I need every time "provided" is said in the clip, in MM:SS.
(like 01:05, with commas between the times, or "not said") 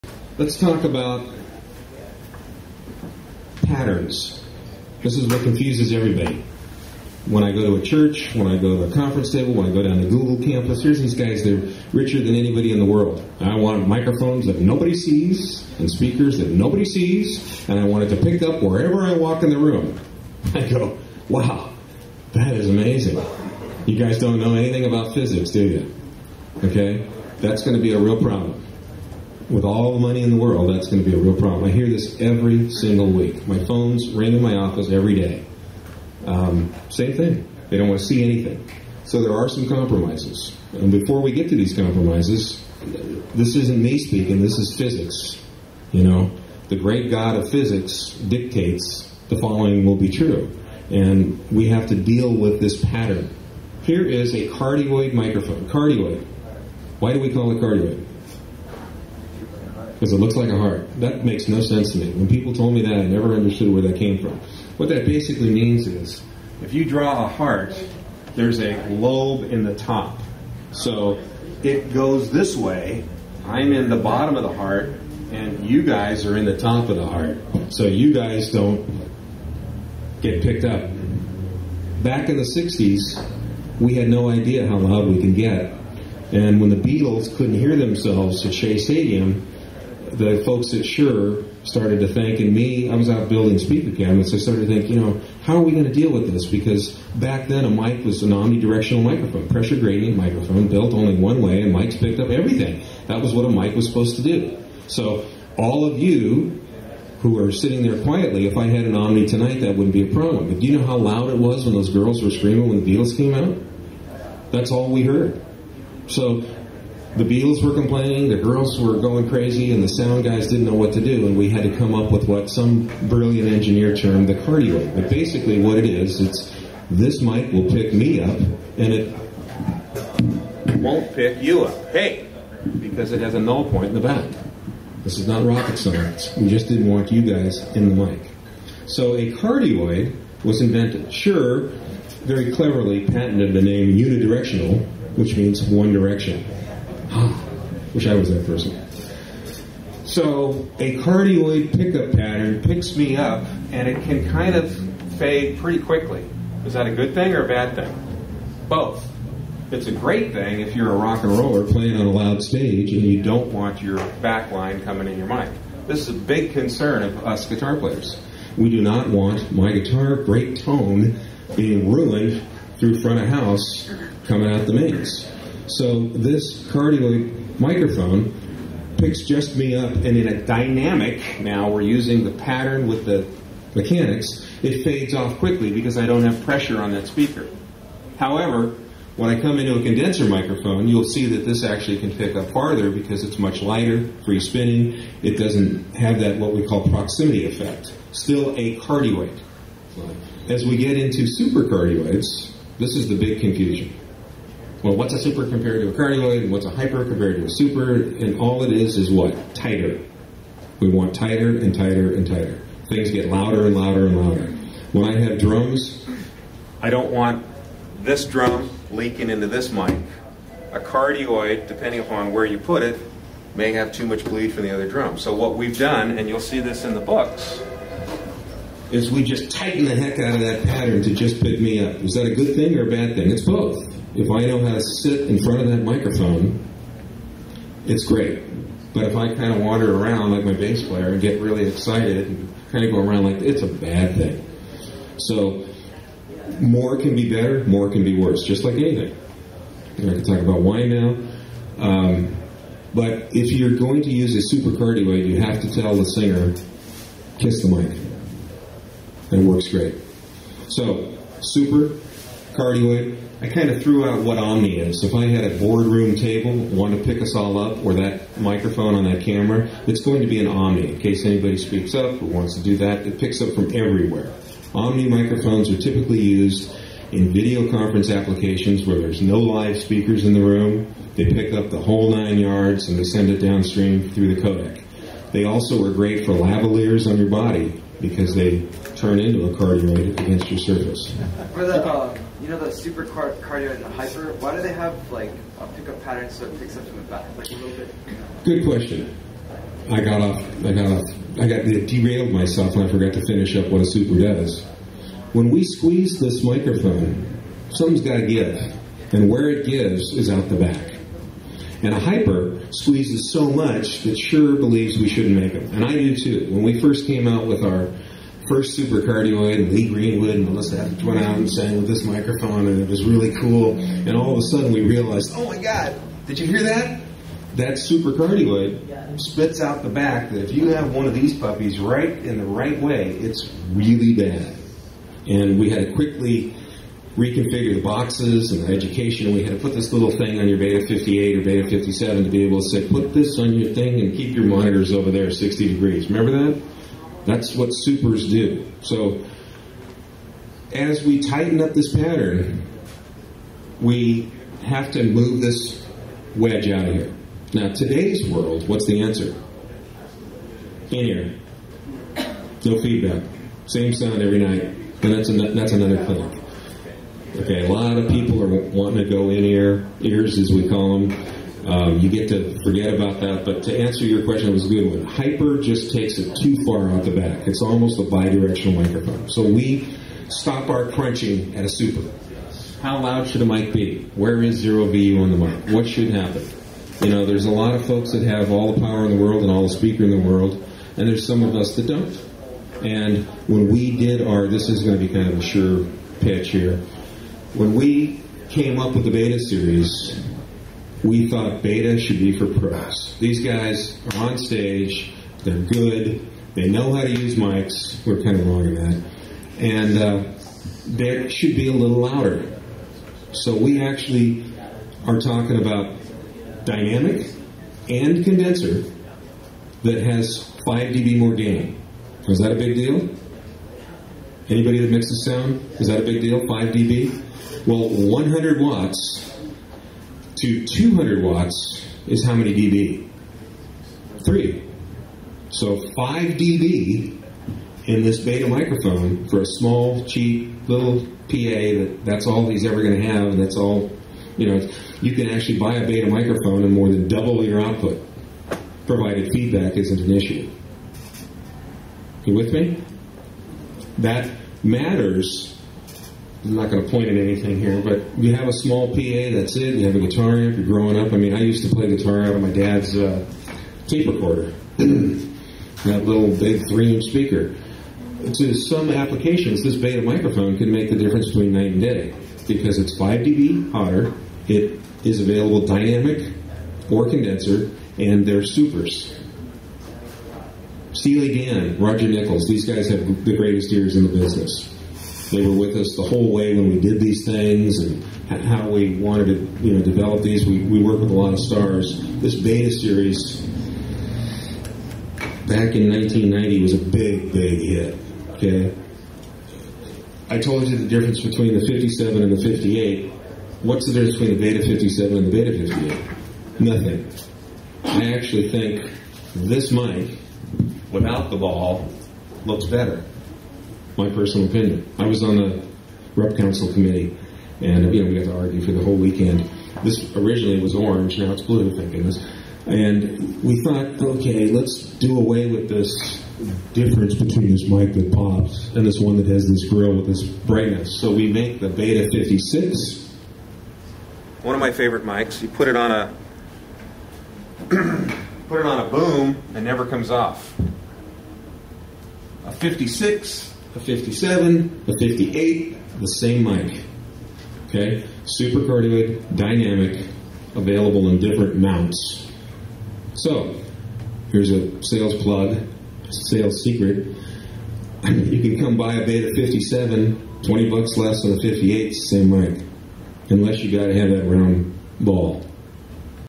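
07:28.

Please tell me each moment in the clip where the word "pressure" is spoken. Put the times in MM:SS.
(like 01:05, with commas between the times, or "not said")
01:39, 03:06.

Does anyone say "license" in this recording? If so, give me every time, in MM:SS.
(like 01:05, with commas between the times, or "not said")
not said.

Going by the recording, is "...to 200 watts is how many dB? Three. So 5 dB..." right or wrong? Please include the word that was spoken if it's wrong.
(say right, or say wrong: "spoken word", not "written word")
right.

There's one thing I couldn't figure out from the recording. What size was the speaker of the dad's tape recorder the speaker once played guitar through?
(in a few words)
3 inch.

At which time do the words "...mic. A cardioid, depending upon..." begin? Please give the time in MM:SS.
03:39.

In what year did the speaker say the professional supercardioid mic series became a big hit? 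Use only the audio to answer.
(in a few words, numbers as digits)
1990.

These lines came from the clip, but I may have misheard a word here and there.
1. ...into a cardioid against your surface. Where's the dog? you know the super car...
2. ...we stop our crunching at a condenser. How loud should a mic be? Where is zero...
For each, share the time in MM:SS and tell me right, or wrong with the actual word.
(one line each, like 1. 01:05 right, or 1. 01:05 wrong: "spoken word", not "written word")
1. 04:49 right
2. 06:19 wrong: "super", not "condenser".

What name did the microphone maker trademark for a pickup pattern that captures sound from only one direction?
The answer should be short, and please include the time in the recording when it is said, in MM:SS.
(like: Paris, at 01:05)
unidirectional, at 02:23.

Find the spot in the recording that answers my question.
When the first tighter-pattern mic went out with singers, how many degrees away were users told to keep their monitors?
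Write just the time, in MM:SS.
05:45.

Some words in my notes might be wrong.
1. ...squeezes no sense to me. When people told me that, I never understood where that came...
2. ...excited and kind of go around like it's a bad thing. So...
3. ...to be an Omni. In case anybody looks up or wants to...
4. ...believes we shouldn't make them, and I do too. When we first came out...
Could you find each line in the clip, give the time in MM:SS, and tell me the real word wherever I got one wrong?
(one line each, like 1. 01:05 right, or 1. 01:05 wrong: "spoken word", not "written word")
1. 01:01 wrong: "makes", not "squeezes"
2. 04:01 right
3. 04:30 wrong: "speaks", not "looks"
4. 05:14 right.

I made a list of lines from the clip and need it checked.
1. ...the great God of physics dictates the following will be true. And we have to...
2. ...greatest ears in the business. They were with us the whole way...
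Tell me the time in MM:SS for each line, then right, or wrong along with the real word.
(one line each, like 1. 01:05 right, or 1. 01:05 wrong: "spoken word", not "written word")
1. 00:46 right
2. 08:03 right.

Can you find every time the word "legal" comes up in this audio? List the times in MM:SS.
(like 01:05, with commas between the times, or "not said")
not said.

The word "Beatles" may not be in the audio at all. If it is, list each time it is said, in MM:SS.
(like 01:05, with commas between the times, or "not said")
01:26, 01:52, 01:57.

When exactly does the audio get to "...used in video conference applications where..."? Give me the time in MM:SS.
04:36.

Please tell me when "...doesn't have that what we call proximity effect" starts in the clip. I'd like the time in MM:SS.
03:15.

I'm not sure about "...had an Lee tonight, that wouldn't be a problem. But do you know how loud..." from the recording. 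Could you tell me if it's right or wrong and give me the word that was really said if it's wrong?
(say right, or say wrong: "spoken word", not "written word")
wrong: "Omni", not "Lee".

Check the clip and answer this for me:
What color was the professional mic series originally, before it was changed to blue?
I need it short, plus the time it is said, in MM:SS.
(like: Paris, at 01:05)
orange, at 08:40.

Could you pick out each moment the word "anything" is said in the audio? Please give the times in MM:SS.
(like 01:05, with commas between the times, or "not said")
00:24, 00:38, 04:08, 07:37.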